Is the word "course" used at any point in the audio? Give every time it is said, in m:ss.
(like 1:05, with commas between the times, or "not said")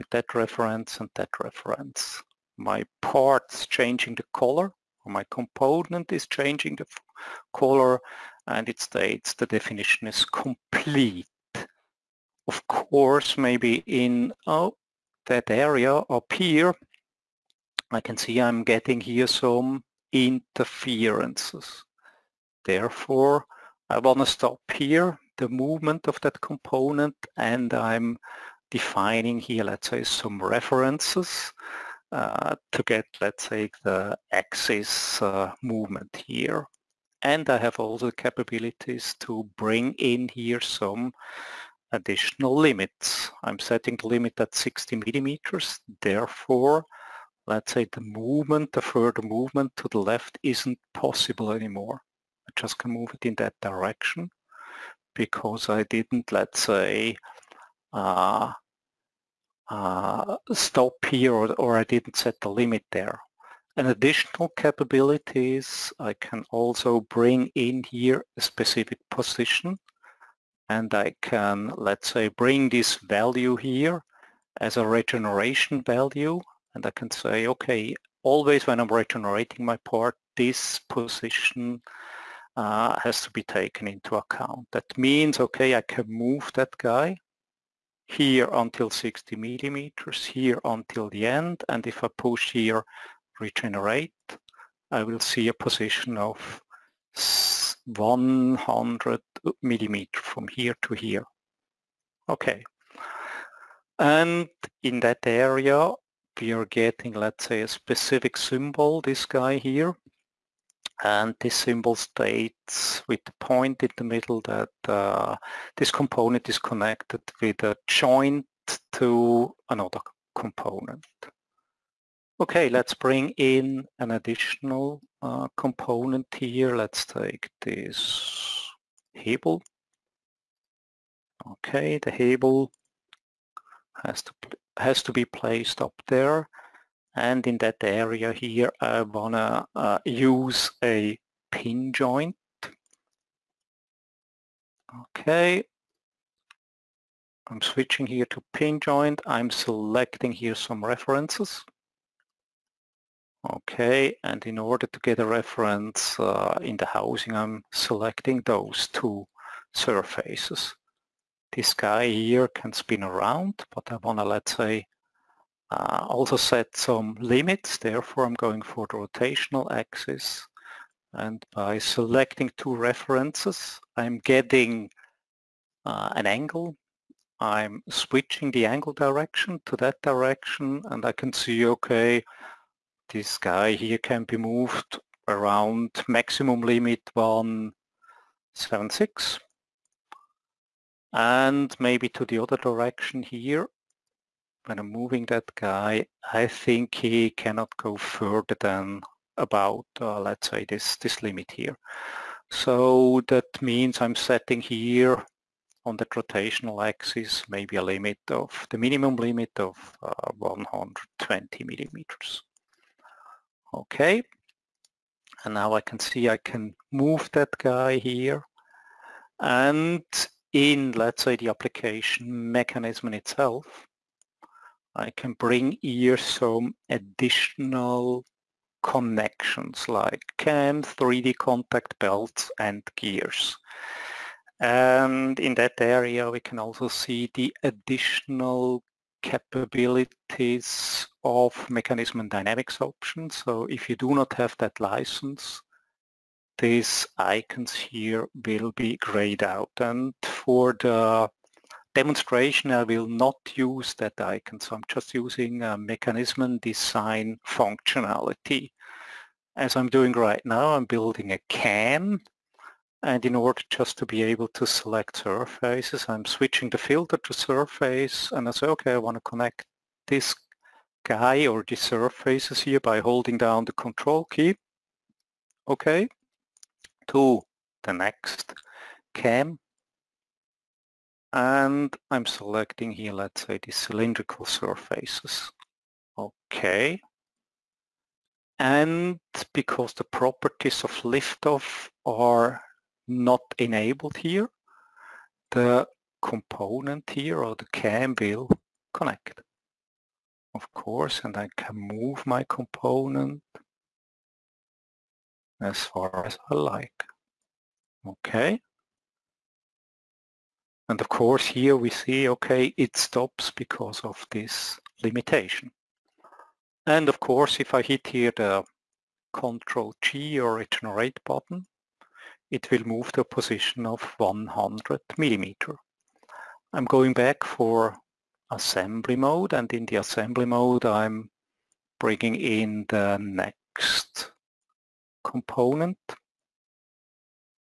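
0:12, 5:00, 5:11, 5:17.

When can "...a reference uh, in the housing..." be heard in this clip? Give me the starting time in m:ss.
2:35.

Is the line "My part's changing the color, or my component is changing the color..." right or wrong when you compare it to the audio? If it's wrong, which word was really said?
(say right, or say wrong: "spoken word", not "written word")
right.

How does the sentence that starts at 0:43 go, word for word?
I'm setting the limit at 60 millimeters.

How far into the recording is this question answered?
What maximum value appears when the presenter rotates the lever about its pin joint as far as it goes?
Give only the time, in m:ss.
3:07.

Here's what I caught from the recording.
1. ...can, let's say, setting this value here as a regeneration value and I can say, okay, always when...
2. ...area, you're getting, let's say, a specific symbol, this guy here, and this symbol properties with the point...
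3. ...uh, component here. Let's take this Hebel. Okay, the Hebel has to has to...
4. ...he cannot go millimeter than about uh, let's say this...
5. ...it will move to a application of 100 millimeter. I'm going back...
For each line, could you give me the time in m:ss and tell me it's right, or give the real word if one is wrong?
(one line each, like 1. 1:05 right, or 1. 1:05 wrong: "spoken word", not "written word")
1. 1:11 wrong: "bring", not "setting"
2. 1:45 wrong: "states", not "properties"
3. 2:05 right
4. 3:16 wrong: "further", not "millimeter"
5. 5:22 wrong: "position", not "application".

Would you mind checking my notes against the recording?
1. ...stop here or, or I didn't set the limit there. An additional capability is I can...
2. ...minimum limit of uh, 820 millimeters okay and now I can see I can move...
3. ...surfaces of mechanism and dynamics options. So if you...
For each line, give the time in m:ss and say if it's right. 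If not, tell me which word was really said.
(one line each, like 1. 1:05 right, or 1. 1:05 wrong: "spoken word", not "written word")
1. 1:00 right
2. 3:28 wrong: "120", not "820"
3. 3:59 wrong: "capabilities", not "surfaces".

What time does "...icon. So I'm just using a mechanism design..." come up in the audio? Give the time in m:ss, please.
4:14.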